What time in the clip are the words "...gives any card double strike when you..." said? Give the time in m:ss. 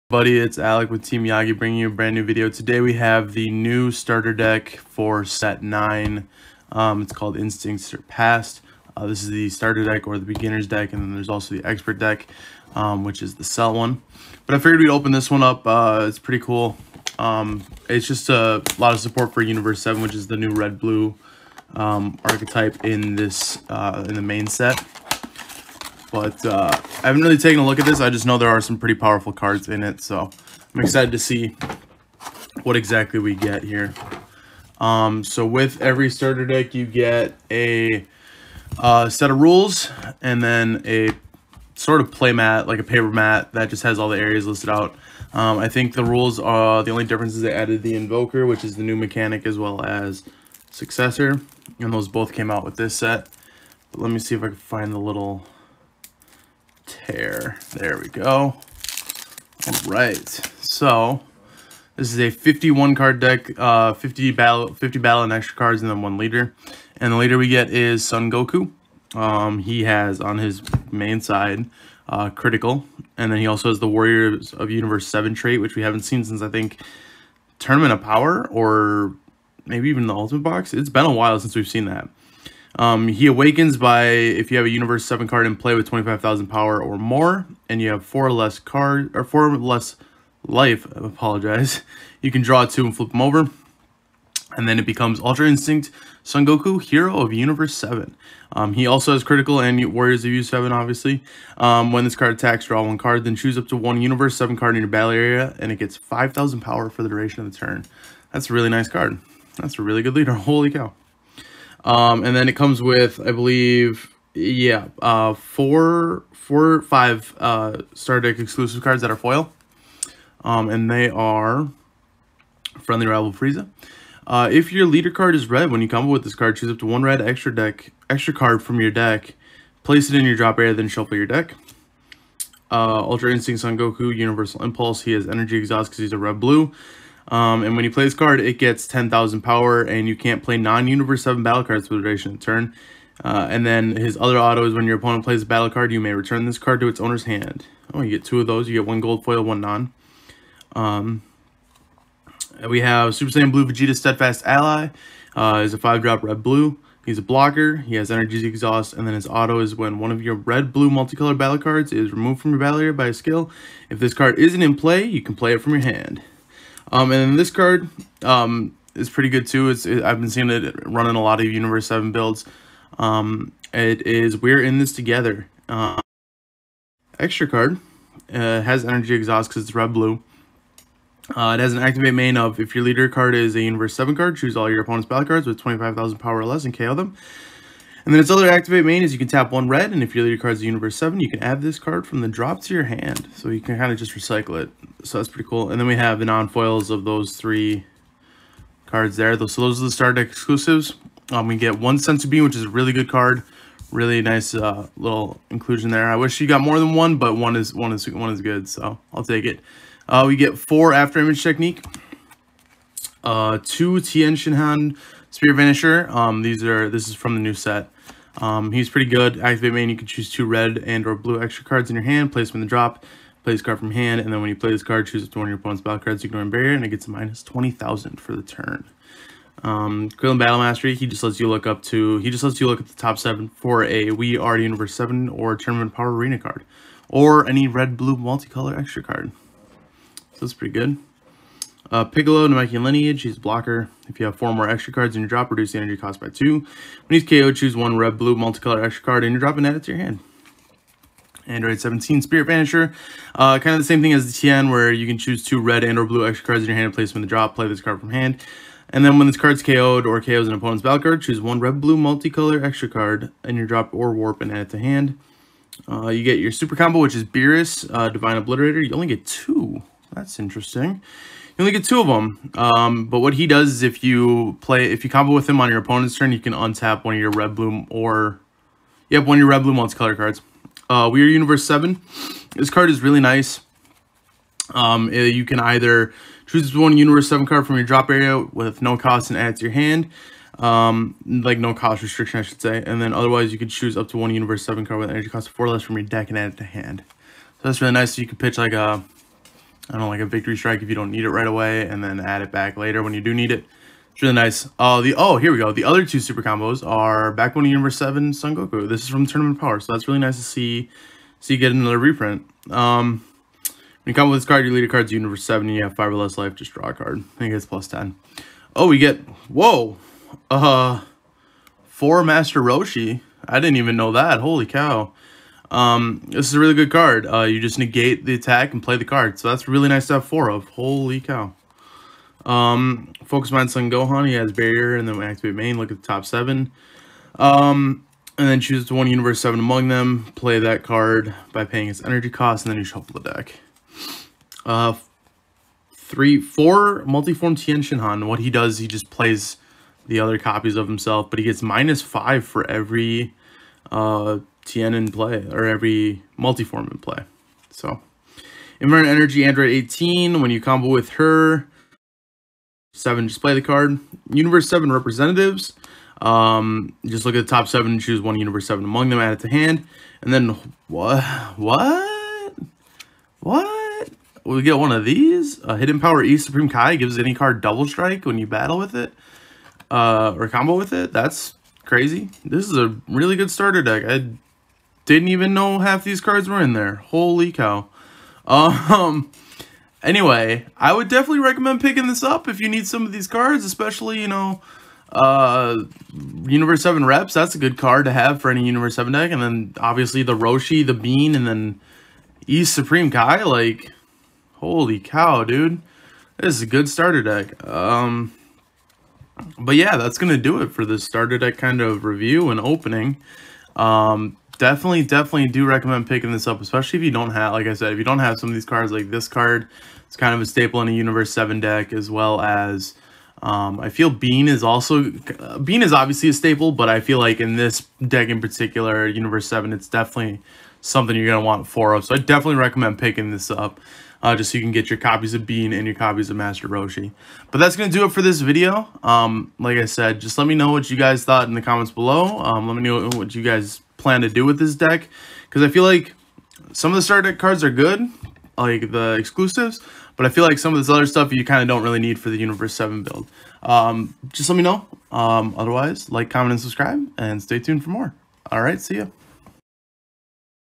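6:16.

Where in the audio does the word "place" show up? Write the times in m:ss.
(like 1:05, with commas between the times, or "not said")
2:09, 3:42, 4:16.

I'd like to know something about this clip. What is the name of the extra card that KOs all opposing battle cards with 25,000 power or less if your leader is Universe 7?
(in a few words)
We're In This Together.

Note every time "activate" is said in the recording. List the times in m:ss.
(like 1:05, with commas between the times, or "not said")
3:01, 3:08, 3:39, 5:35.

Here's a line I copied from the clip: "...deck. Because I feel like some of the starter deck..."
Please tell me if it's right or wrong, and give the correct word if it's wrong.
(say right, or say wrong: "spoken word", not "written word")
right.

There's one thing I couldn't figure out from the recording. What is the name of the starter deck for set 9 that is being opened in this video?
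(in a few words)
Instinct Surpassed.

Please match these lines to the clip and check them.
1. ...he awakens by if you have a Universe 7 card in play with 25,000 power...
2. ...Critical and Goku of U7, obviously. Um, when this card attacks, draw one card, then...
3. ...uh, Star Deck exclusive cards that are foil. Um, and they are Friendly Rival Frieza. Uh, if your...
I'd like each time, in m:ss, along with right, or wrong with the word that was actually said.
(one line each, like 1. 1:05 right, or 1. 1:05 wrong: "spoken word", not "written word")
1. 1:23 right
2. 1:39 wrong: "Warriors", not "Goku"
3. 1:57 right.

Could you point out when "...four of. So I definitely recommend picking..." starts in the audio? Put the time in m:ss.
7:11.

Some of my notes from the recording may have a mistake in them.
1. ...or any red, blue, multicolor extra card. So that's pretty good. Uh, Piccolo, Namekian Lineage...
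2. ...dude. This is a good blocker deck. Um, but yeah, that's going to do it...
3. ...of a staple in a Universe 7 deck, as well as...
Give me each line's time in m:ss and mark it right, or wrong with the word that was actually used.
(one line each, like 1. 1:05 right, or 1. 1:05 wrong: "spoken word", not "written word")
1. 3:57 right
2. 6:45 wrong: "starter", not "blocker"
3. 7:00 right.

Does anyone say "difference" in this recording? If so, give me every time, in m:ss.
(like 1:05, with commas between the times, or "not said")
0:47.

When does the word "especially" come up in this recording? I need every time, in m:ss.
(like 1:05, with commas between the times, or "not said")
6:33, 6:56.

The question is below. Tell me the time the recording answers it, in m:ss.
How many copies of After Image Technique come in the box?
3:30.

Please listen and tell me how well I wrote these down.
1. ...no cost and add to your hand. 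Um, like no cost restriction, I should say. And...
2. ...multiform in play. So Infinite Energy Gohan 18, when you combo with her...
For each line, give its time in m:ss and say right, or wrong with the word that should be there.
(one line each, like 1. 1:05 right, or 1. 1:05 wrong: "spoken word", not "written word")
1. 4:48 right
2. 5:56 wrong: "Android", not "Gohan".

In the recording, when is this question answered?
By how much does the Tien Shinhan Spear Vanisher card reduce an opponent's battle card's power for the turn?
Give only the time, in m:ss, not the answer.
3:47.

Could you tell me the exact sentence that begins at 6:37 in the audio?
That's a good card to have for any Universe 7 deck.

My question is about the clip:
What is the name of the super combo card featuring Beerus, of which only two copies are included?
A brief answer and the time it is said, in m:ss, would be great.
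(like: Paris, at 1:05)
Divine Obliterator, at 4:28.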